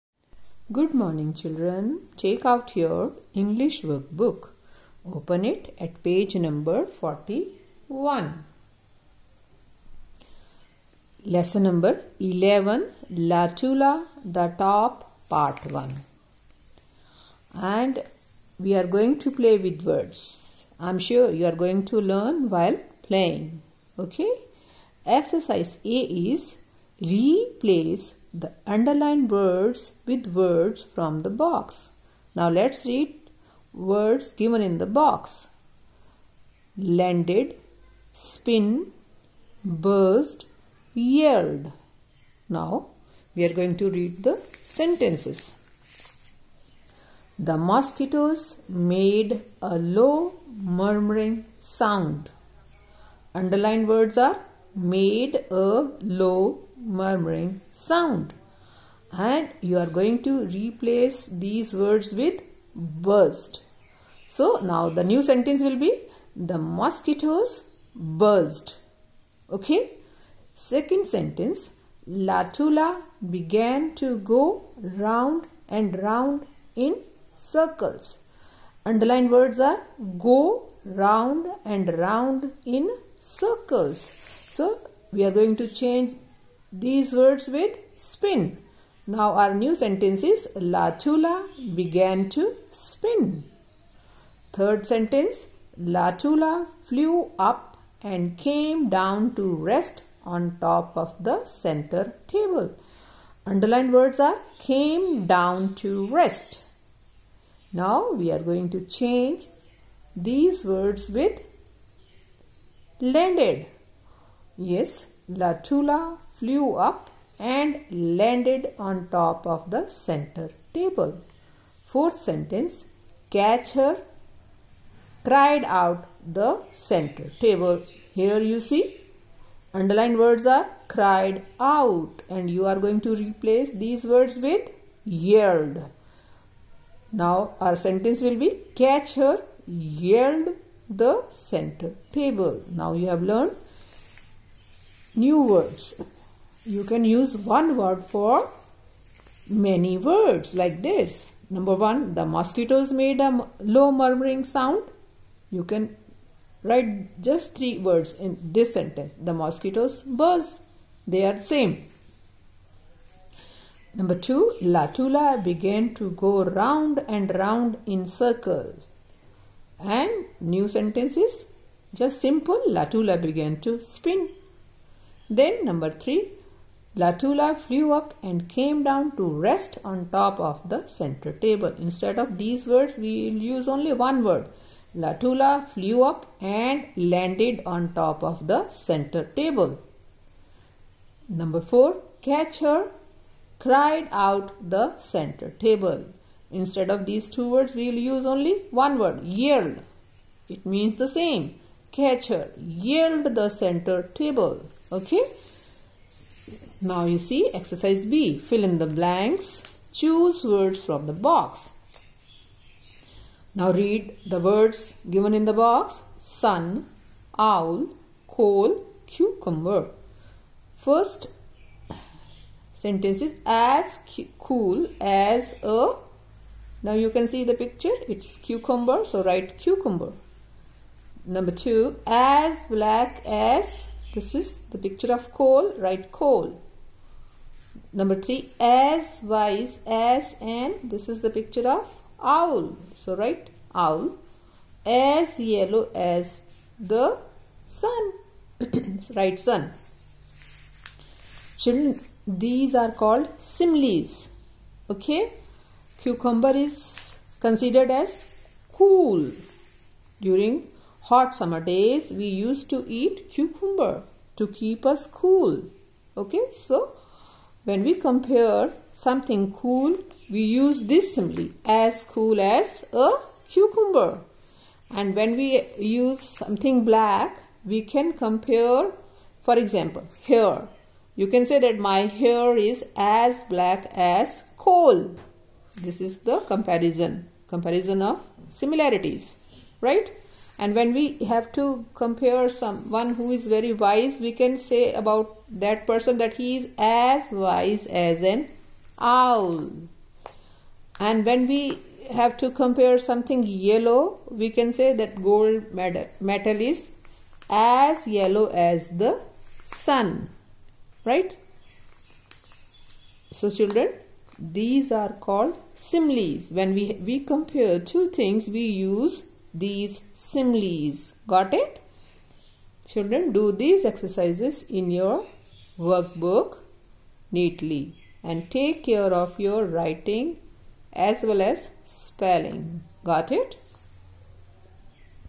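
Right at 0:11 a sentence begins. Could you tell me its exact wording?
Lesson number 11 Latula, the top, part 1.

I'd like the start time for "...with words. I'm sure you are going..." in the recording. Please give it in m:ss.
0:19.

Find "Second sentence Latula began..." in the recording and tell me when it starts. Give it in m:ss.
1:10.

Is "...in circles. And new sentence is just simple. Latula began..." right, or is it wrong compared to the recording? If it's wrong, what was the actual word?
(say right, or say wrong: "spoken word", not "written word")
right.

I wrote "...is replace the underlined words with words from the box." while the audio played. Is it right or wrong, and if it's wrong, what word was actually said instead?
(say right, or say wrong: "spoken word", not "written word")
right.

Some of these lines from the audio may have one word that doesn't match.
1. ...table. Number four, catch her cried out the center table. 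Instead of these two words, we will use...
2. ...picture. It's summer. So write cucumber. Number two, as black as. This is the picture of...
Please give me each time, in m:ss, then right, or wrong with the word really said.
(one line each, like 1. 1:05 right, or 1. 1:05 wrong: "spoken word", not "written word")
1. 3:09 right
2. 3:47 wrong: "cucumber", not "summer".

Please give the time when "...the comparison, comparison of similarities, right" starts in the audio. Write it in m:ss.
4:46.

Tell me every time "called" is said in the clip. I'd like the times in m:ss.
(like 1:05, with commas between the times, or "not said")
4:12, 5:15.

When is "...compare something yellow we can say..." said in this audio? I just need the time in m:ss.
5:02.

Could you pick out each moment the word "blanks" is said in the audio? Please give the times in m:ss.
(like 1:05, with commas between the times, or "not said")
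3:28.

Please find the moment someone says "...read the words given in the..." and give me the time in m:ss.
3:33.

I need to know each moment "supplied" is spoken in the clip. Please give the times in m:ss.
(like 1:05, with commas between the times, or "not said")
not said.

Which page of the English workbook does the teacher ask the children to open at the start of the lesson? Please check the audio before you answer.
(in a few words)
41.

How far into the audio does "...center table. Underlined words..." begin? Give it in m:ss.
1:41.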